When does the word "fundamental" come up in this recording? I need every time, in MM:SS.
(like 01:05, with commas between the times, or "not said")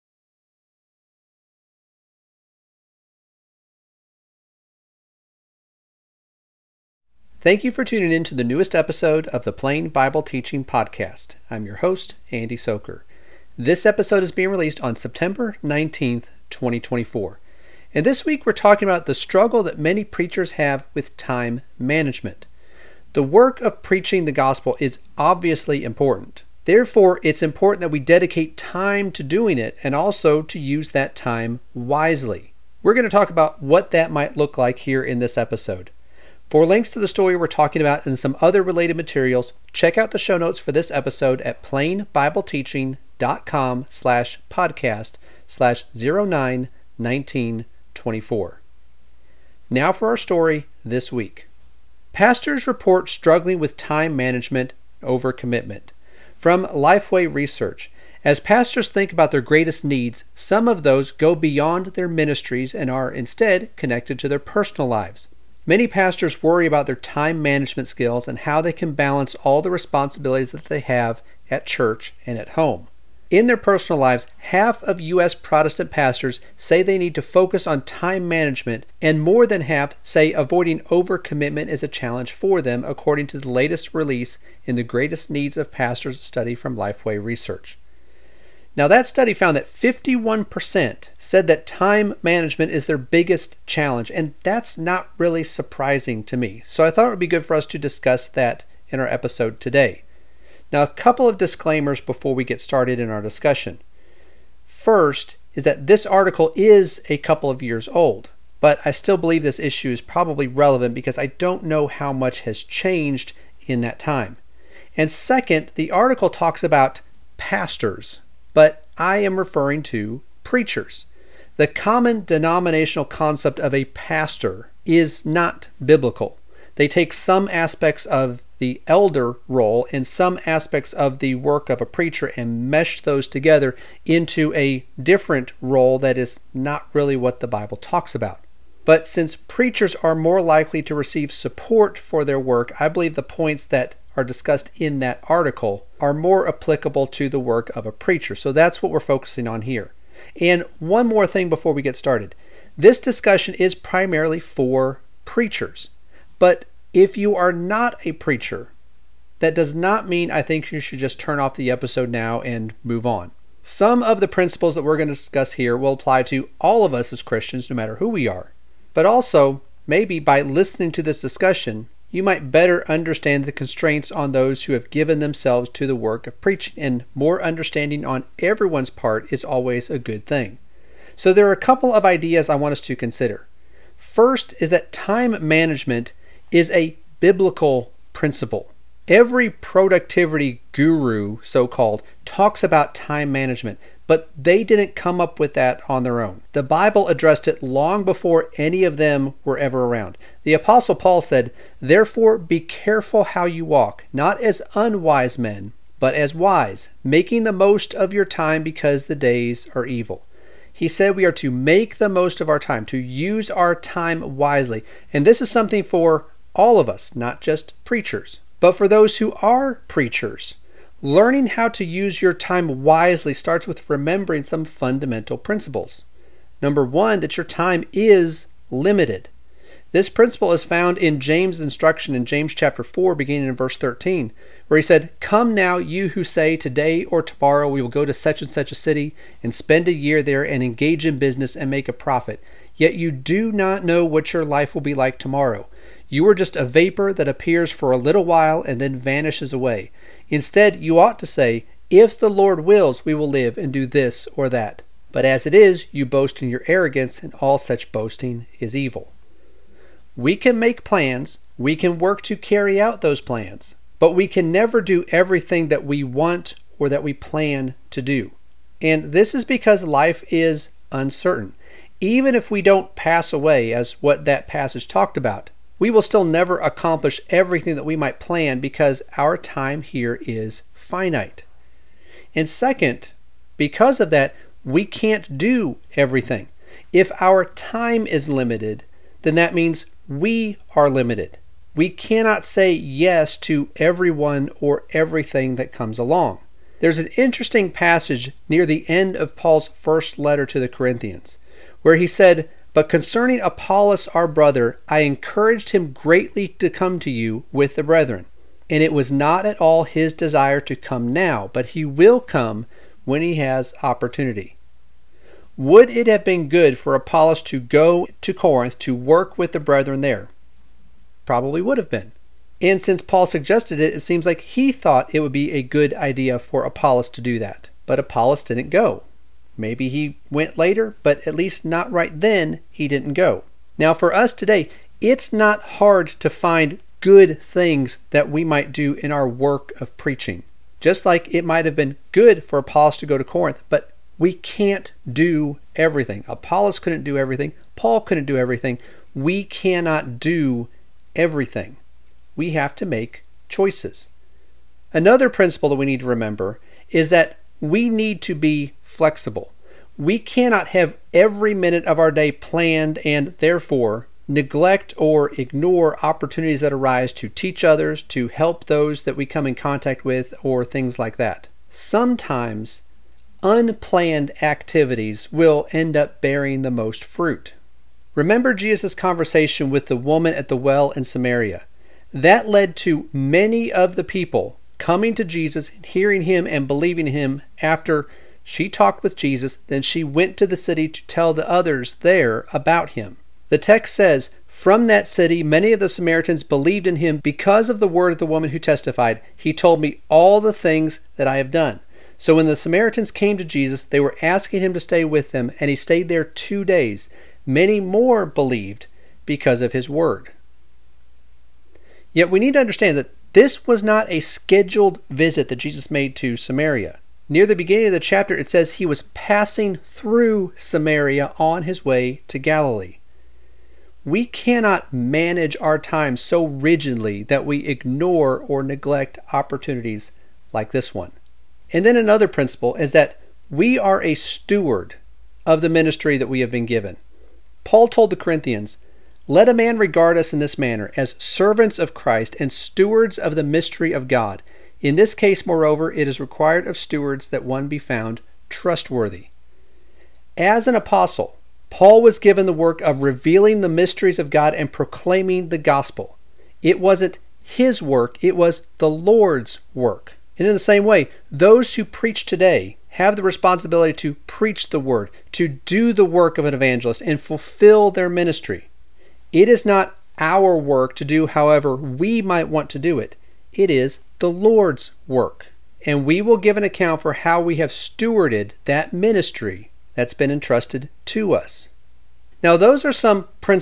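03:44.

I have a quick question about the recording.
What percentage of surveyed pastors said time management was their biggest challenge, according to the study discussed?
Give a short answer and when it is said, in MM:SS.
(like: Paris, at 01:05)
51%, at 01:29.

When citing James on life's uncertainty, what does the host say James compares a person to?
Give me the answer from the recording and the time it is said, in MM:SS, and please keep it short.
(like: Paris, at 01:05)
A vapor, at 04:06.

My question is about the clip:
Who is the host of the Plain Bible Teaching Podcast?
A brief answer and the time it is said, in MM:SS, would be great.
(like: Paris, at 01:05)
Andy Sochor, at 00:12.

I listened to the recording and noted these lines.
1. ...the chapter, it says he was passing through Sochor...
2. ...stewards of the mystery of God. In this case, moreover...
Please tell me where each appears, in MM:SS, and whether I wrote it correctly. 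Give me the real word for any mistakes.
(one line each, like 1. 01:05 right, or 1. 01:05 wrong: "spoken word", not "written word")
1. 06:57 wrong: "Samaria", not "Sochor"
2. 07:22 right.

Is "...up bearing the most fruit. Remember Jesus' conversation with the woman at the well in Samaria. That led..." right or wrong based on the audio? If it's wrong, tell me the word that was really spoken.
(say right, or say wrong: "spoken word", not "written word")
right.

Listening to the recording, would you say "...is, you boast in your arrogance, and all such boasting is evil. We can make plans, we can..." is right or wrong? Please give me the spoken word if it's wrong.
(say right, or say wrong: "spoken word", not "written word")
right.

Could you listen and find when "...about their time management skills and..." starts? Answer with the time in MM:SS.
01:06.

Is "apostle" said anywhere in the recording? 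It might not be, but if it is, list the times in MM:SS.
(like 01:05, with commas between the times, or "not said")
03:20, 07:30.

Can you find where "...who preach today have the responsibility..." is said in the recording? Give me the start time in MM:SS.
07:41.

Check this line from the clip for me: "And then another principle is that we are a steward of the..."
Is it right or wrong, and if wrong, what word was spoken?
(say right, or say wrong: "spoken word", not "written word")
right.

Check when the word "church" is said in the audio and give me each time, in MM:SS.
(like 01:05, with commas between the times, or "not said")
01:11.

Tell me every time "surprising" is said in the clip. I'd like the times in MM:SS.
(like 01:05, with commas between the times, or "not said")
01:35.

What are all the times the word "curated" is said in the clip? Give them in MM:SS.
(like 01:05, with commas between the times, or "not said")
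not said.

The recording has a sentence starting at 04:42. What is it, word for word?
And second, because of that, we can't do everything.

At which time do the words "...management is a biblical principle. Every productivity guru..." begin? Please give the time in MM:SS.
03:05.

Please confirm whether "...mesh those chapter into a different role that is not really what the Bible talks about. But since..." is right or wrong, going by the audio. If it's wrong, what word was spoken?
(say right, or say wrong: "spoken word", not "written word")
wrong: "together", not "chapter".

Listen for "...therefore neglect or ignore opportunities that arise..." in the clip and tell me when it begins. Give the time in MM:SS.
06:03.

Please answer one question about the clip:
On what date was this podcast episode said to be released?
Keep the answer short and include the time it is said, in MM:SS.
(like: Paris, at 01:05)
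September 19th, 2024, at 00:14.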